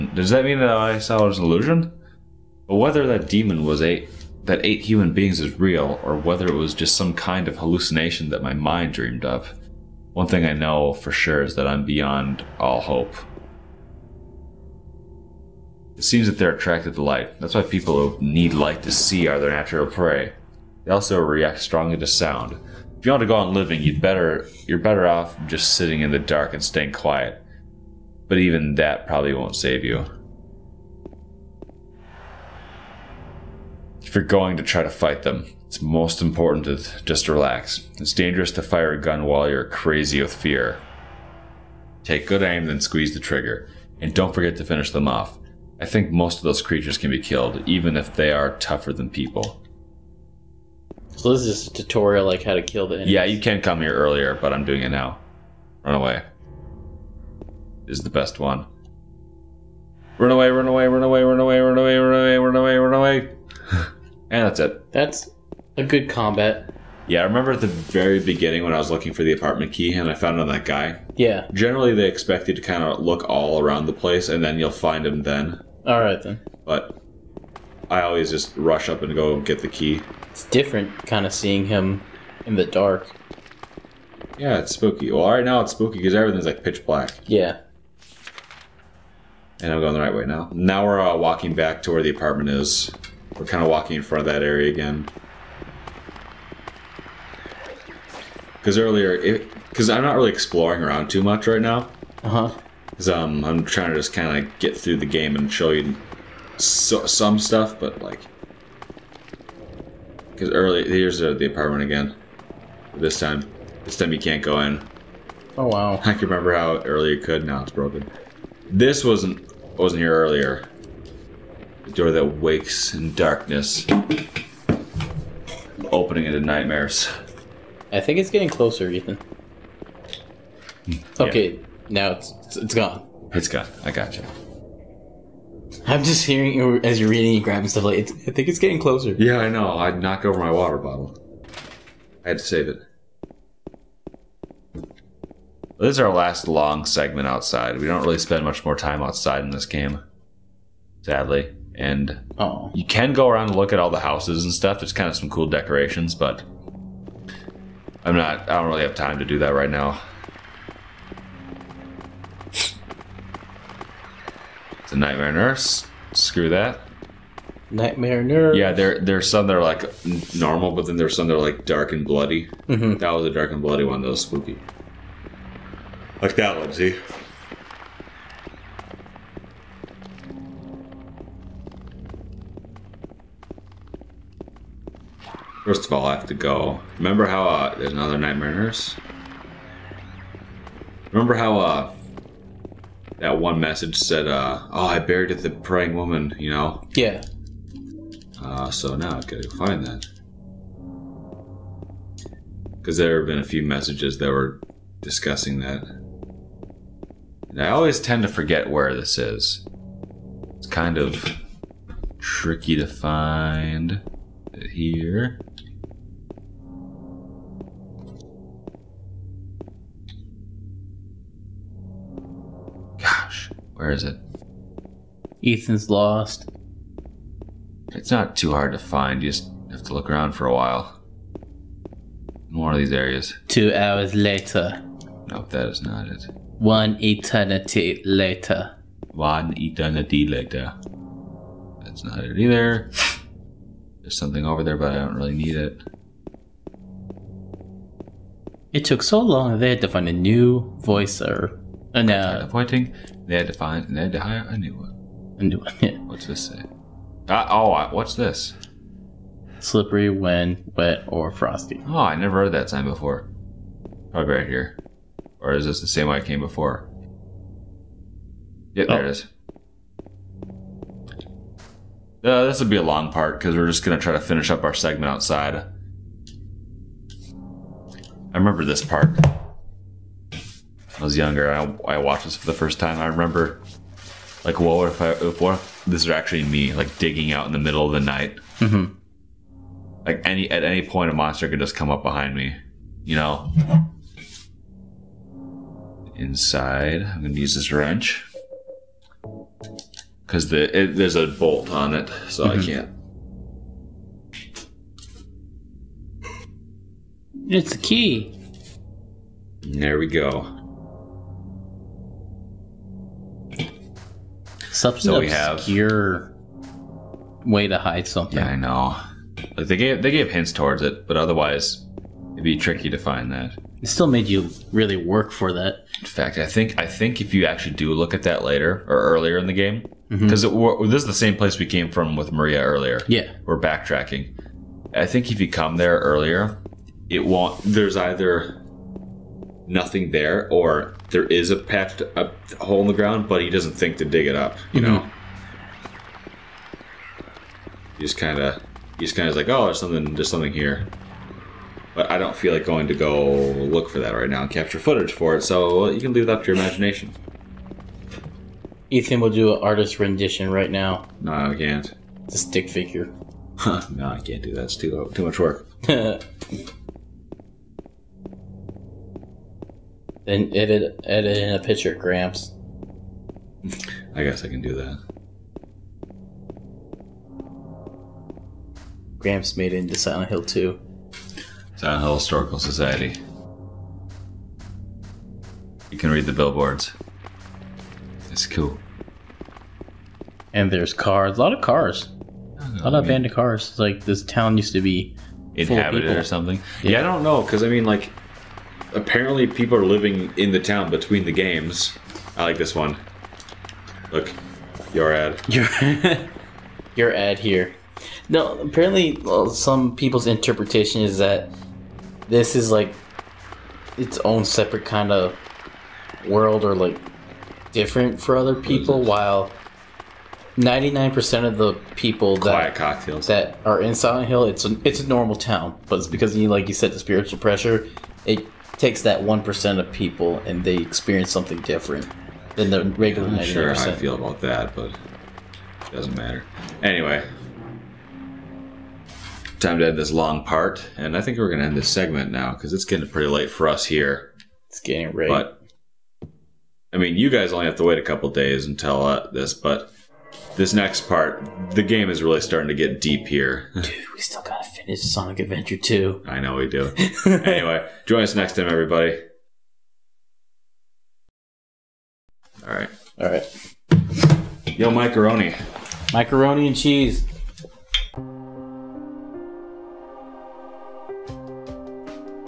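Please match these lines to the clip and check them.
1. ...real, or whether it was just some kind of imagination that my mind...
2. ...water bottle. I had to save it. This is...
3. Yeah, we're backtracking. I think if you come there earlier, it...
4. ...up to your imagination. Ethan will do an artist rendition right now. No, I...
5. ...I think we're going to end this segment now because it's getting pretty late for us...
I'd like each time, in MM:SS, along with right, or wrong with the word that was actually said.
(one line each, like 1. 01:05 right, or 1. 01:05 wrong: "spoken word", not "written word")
1. 00:05 wrong: "hallucination", not "imagination"
2. 02:20 right
3. 05:33 right
4. 05:56 right
5. 07:21 right.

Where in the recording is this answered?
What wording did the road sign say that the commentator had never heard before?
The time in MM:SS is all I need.
04:19.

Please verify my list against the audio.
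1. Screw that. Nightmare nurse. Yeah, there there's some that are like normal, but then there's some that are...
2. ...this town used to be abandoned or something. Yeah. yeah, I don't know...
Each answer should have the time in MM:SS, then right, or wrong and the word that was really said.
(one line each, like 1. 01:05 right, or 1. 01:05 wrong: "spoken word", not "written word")
1. 02:46 right
2. 06:34 wrong: "inhabited", not "abandoned".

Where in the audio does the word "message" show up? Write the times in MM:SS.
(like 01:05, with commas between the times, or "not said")
03:13, 03:23.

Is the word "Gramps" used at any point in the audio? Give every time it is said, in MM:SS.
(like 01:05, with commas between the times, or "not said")
06:11, 06:19.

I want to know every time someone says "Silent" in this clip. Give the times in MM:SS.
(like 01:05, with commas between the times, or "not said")
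06:19, 07:03.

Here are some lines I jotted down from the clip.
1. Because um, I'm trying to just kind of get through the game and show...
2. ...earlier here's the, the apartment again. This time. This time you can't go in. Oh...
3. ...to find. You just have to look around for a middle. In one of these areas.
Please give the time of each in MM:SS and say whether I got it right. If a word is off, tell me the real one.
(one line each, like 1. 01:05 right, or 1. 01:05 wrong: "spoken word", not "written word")
1. 01:42 right
2. 01:50 right
3. 03:48 wrong: "while", not "middle".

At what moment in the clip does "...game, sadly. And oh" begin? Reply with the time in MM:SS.
02:29.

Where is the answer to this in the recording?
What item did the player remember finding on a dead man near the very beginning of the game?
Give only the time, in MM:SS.
01:09.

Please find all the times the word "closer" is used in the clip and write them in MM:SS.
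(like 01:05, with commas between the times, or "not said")
02:08, 02:18.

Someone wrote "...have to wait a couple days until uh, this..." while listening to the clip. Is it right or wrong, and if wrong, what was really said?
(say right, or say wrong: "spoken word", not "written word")
right.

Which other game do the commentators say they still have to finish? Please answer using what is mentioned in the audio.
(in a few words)
Sonic Adventure 2.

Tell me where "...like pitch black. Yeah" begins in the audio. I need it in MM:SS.
01:26.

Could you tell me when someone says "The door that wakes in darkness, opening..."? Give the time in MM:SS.
02:01.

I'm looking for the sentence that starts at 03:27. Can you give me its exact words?
And I always tend to forget where this is.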